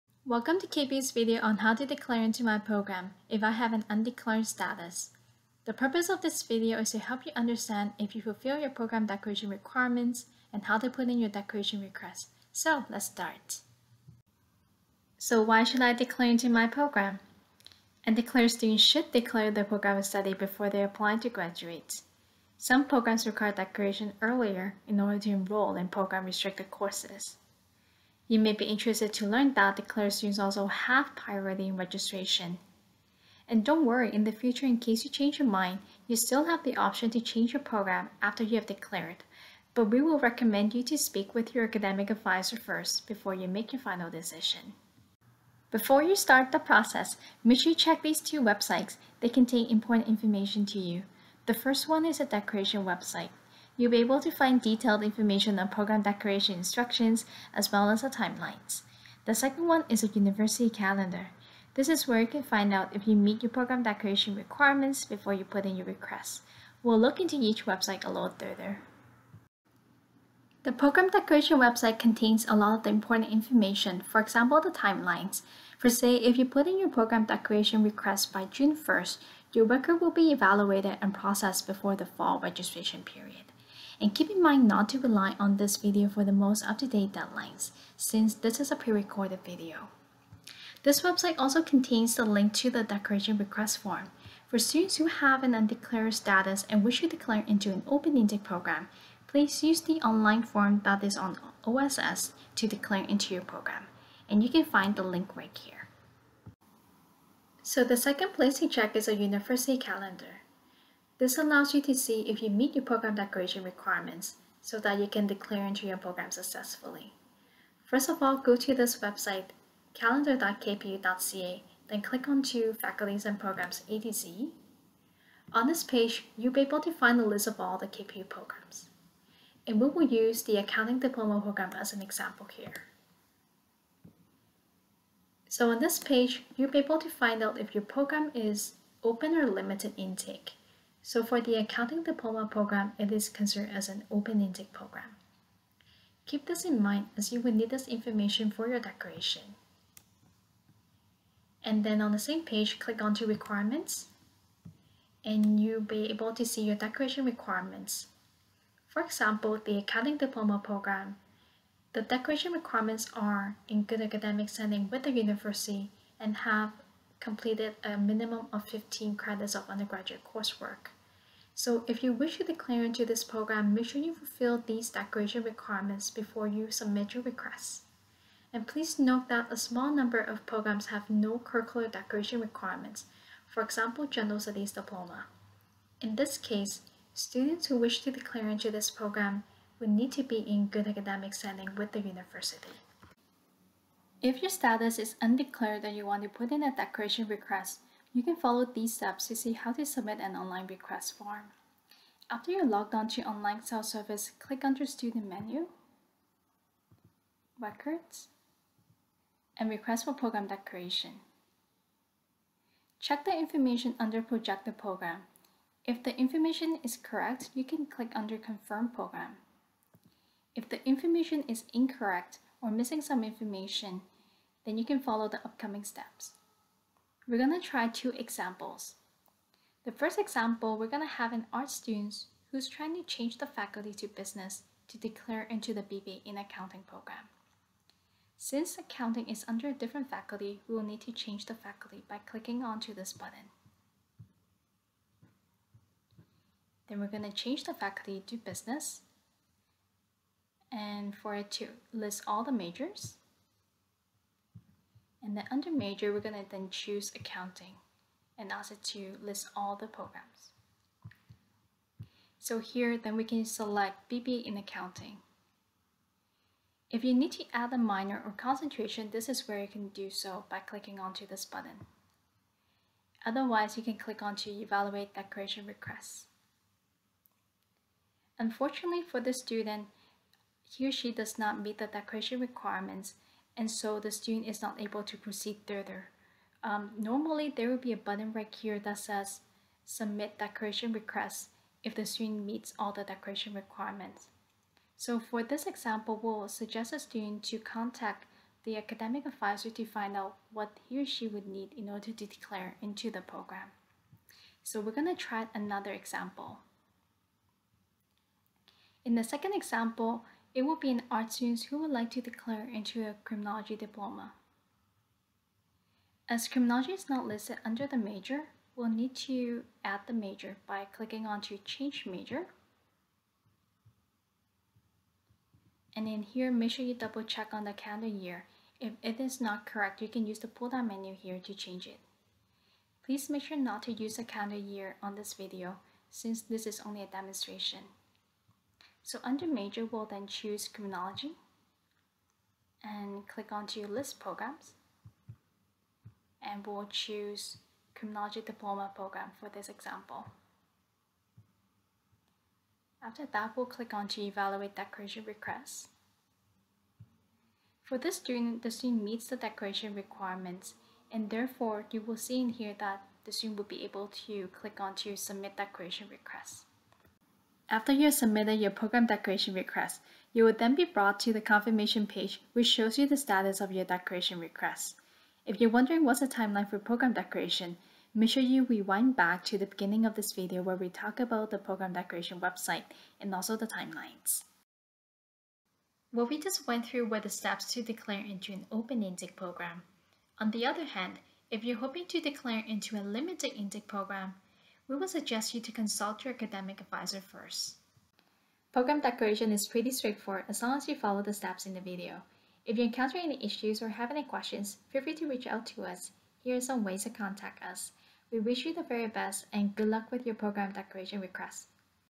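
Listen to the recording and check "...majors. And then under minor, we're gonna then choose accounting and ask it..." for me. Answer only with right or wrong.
wrong.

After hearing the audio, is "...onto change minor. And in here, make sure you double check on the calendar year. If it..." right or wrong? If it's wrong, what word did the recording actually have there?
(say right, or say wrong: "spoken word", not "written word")
wrong: "major", not "minor".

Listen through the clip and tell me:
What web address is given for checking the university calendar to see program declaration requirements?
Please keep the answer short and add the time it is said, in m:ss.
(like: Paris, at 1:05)
calendar.kpu.ca, at 1:59.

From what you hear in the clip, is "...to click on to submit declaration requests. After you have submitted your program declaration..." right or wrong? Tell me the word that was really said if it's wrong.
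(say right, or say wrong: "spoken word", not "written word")
right.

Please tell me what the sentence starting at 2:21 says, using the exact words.
So for the accounting diploma program, it is considered as an open intake program.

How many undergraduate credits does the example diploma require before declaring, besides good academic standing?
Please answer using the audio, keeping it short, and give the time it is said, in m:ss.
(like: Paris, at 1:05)
15, at 2:48.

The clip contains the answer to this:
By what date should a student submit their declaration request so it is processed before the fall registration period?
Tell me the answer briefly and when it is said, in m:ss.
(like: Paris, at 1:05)
June 1st, at 1:18.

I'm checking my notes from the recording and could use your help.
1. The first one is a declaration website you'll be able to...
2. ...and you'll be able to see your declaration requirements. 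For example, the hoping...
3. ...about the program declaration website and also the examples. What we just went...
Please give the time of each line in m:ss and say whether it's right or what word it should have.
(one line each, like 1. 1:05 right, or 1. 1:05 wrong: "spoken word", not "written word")
1. 0:51 right
2. 2:35 wrong: "accounting", not "hoping"
3. 6:21 wrong: "timelines", not "examples".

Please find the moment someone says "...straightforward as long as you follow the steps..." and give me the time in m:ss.
6:39.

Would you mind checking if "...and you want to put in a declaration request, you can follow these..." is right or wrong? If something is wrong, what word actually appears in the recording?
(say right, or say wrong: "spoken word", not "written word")
right.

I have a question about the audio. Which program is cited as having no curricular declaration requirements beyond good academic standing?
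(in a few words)
General Studies Diploma.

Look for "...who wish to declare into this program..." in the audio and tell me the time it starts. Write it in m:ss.
3:07.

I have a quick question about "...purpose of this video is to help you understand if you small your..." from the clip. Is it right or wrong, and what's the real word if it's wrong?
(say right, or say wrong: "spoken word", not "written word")
wrong: "fulfill", not "small".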